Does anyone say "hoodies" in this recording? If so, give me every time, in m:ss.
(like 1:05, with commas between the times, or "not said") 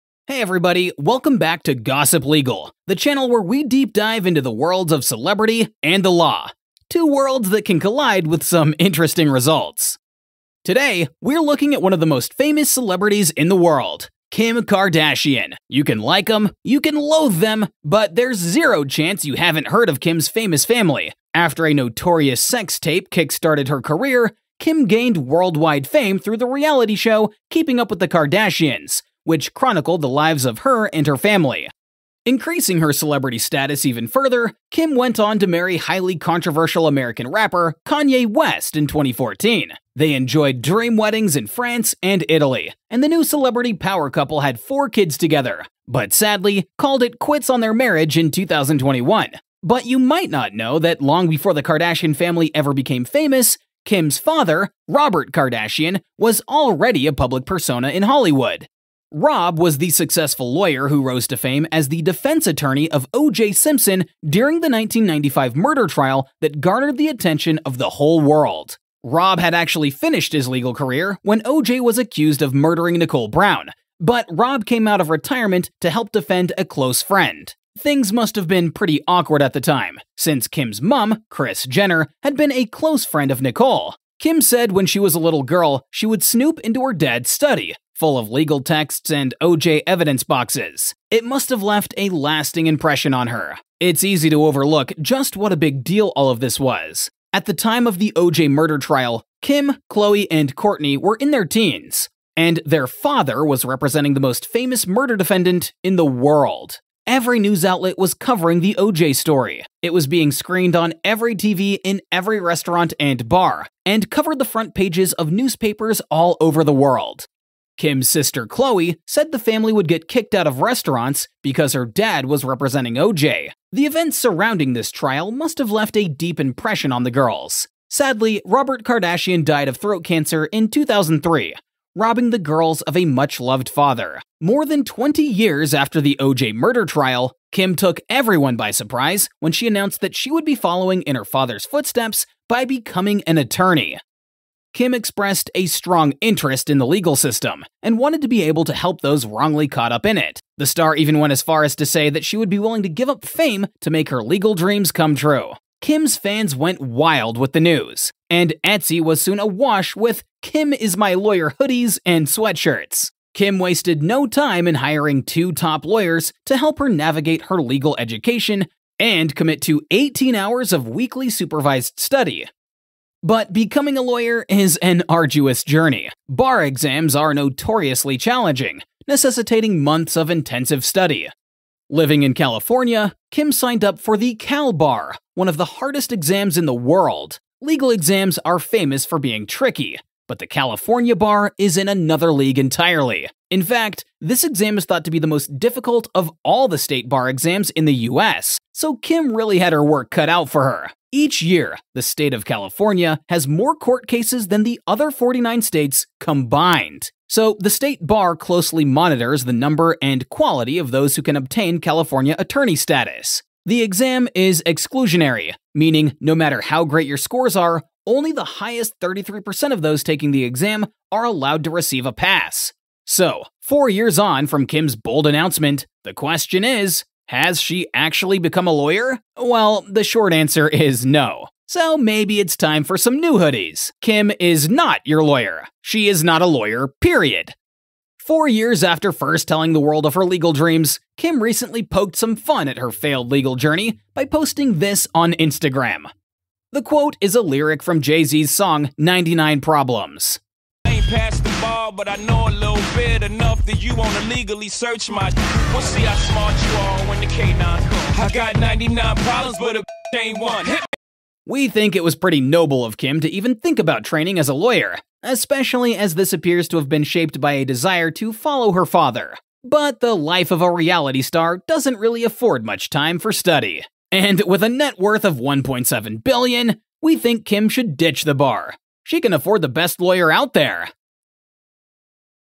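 2:41, 3:53.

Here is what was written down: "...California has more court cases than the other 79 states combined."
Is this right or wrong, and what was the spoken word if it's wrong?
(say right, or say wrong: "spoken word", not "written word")
wrong: "49", not "79".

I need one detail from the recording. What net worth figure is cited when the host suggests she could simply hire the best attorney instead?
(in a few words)
1.7 billion.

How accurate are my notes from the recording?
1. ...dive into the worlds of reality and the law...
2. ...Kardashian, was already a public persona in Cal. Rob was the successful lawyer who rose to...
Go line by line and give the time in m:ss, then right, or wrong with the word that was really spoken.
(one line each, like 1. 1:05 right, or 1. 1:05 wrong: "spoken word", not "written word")
1. 0:03 wrong: "celebrity", not "reality"
2. 0:55 wrong: "Hollywood", not "Cal".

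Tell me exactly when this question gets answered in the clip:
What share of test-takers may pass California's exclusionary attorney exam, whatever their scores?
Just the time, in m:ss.
3:38.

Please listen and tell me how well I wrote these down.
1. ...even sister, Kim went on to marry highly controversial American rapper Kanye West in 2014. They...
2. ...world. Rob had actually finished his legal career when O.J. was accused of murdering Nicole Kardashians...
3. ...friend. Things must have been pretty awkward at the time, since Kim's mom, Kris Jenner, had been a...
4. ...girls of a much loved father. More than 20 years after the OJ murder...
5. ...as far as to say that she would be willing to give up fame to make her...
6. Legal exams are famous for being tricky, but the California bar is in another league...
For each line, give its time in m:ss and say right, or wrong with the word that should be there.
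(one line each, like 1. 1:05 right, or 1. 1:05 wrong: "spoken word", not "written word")
1. 0:33 wrong: "further", not "sister"
2. 1:08 wrong: "Brown", not "Kardashians"
3. 1:17 right
4. 2:12 right
5. 2:31 right
6. 3:07 right.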